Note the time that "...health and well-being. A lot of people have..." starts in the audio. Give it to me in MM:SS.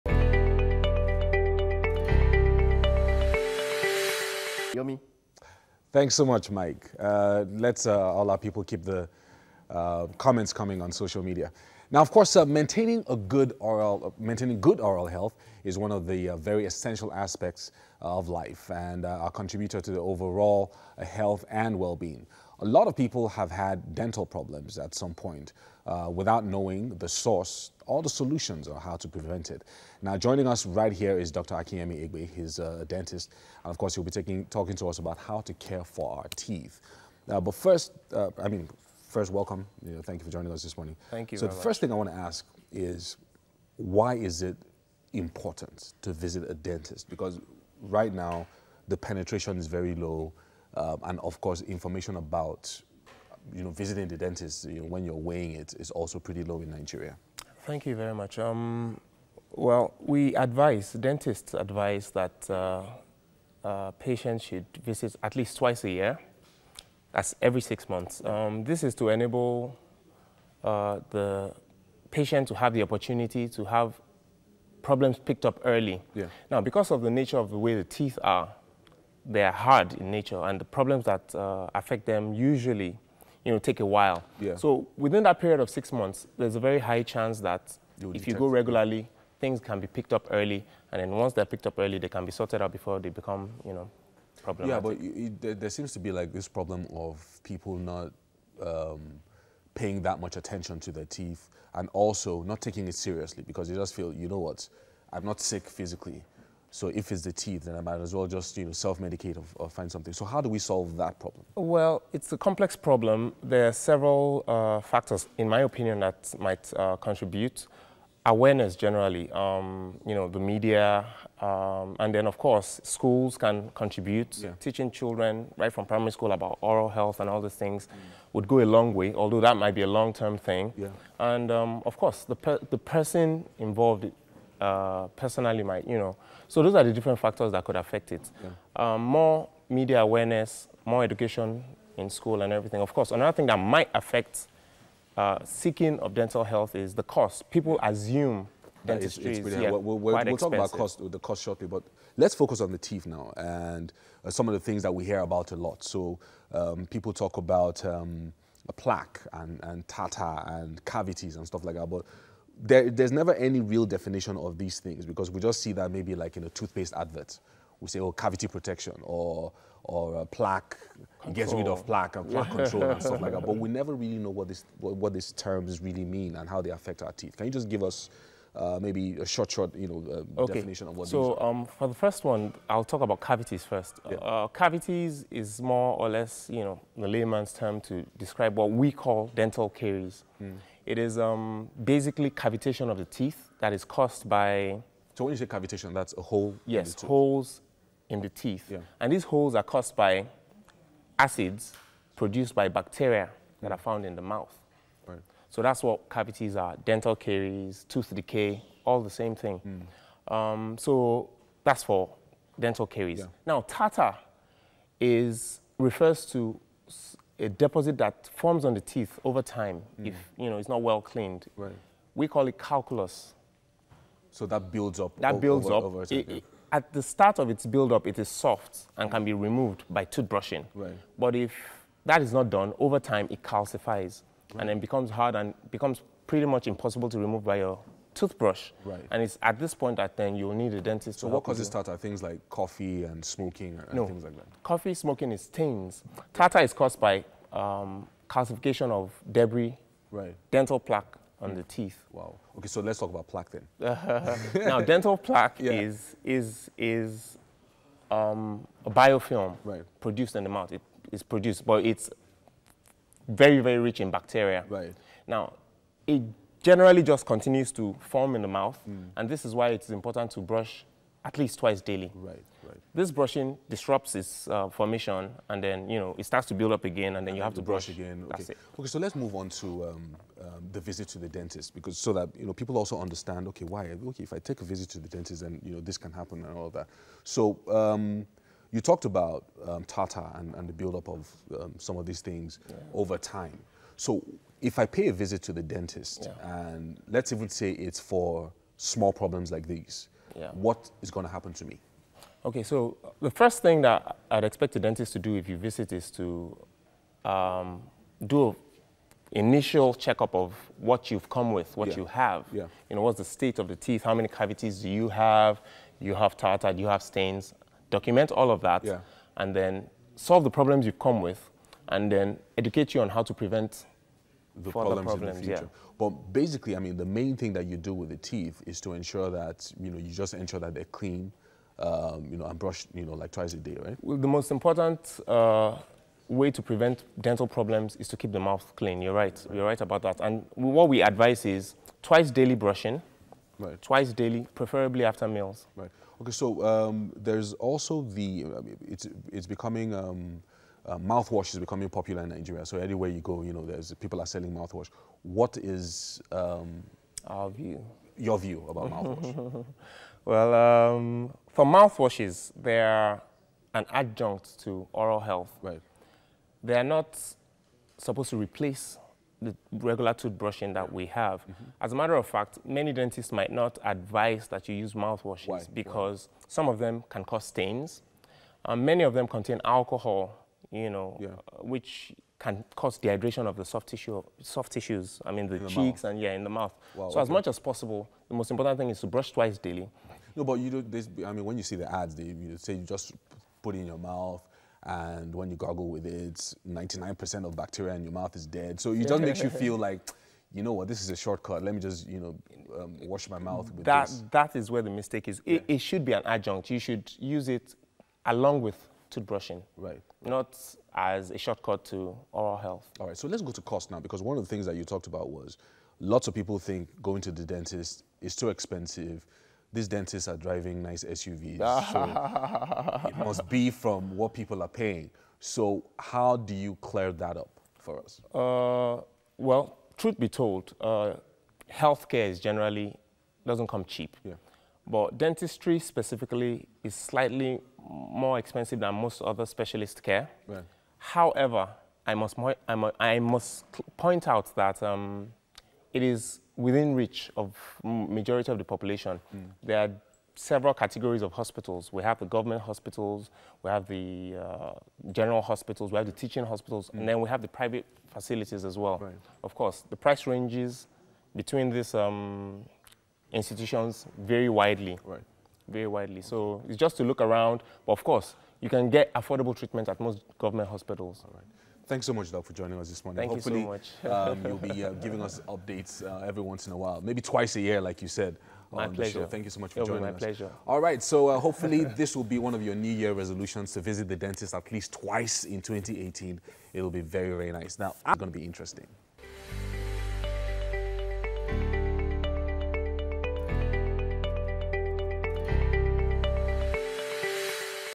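00:21.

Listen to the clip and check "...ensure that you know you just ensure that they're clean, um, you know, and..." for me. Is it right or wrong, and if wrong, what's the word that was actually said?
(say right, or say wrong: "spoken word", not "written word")
right.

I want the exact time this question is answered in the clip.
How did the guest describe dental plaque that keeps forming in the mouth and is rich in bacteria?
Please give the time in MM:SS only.
04:18.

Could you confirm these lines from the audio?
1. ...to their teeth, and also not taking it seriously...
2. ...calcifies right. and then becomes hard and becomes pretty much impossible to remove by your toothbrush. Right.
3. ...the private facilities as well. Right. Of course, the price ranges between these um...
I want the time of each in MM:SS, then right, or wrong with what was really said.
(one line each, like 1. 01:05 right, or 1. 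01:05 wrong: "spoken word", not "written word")
1. 01:40 right
2. 03:53 right
3. 07:37 right.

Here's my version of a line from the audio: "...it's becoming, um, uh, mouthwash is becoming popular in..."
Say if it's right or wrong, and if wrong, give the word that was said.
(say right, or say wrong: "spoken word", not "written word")
right.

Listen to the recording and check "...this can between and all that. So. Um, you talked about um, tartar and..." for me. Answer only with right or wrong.
wrong.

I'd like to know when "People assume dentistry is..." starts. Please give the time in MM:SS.
02:27.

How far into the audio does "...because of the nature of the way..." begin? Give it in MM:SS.
01:16.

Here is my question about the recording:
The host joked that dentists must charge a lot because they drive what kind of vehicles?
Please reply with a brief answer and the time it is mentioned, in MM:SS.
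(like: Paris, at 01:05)
SUVs, at 07:00.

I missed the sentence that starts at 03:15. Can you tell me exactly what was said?
So when you say cavitation, that's a hole Yes, in holes in the teeth.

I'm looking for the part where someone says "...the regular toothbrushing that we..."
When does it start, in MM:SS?
06:09.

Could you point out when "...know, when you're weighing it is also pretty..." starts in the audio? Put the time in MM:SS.
00:54.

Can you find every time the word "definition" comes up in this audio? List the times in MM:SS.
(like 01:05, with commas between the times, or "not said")
02:43, 03:00.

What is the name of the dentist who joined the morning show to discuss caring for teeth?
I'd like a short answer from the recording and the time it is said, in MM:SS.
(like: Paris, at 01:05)
Akinyemi Egbe, at 00:31.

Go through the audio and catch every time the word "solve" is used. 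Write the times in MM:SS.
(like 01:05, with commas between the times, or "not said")
01:50, 05:20.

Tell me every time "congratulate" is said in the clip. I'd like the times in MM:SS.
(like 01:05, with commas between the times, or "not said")
not said.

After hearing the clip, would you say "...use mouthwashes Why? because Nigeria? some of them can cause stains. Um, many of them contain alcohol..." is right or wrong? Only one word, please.
wrong.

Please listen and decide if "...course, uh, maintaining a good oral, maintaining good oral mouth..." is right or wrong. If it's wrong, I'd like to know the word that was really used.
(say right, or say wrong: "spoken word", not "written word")
wrong: "health", not "mouth".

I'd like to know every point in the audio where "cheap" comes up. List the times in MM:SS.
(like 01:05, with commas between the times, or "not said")
07:13.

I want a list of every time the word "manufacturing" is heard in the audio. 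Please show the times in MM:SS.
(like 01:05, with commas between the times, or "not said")
not said.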